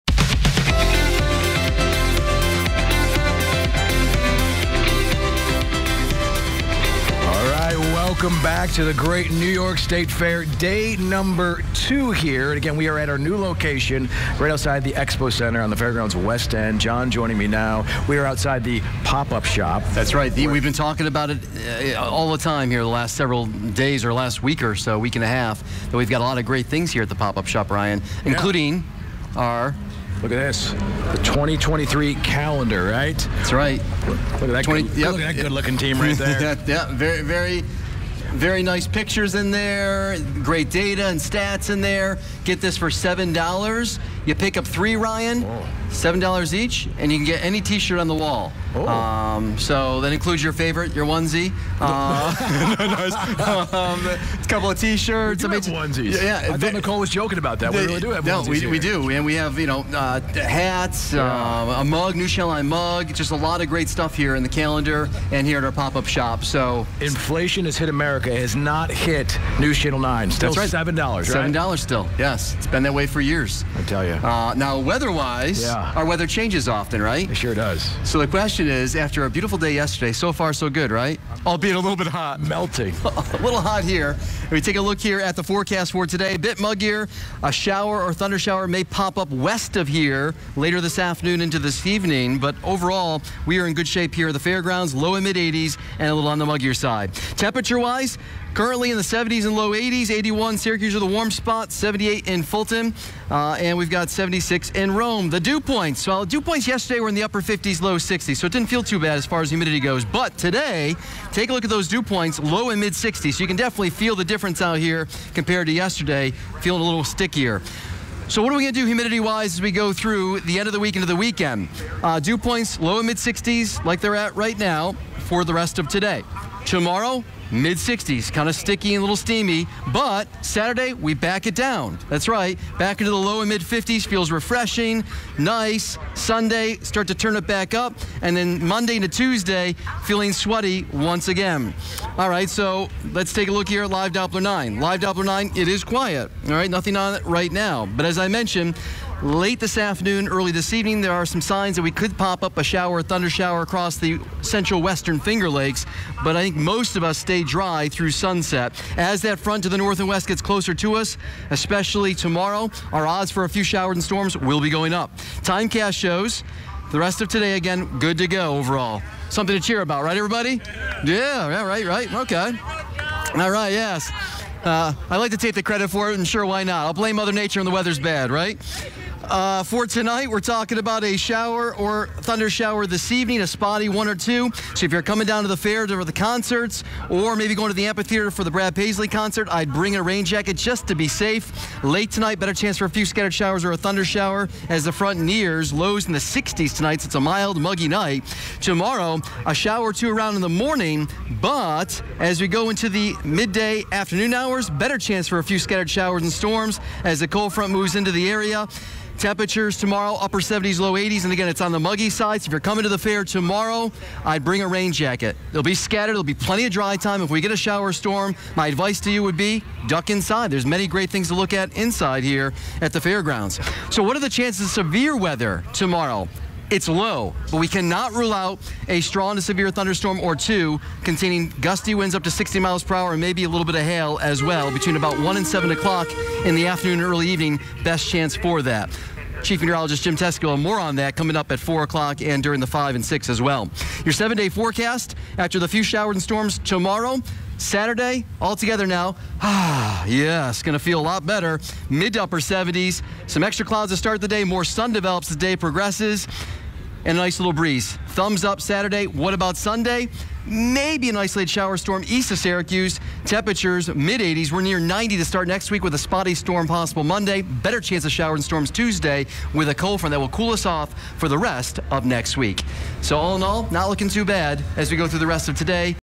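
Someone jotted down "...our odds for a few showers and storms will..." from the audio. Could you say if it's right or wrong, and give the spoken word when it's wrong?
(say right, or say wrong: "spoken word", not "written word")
right.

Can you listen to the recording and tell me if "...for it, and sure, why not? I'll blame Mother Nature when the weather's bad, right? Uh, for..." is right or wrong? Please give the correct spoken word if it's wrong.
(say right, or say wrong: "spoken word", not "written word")
right.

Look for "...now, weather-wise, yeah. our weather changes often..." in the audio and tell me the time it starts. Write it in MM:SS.
01:14.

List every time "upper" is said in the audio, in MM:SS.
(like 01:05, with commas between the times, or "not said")
01:47, 03:30, 04:12.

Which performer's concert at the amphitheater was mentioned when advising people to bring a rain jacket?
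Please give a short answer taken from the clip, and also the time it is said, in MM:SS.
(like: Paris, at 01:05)
Brad Paisley, at 03:08.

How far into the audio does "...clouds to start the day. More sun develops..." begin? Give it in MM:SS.
04:13.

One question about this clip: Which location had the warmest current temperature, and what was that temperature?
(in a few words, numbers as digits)
Syracuse, 81.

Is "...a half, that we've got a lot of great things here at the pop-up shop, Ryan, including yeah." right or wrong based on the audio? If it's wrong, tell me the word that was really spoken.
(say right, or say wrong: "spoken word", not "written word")
right.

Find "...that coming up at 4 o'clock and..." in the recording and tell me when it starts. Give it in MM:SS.
04:00.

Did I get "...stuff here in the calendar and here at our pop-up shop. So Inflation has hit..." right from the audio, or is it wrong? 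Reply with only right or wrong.
right.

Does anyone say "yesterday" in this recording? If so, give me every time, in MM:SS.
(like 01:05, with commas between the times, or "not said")
01:19, 01:46, 01:55.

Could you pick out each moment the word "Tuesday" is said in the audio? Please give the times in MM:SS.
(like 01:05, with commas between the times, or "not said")
02:19, 04:28.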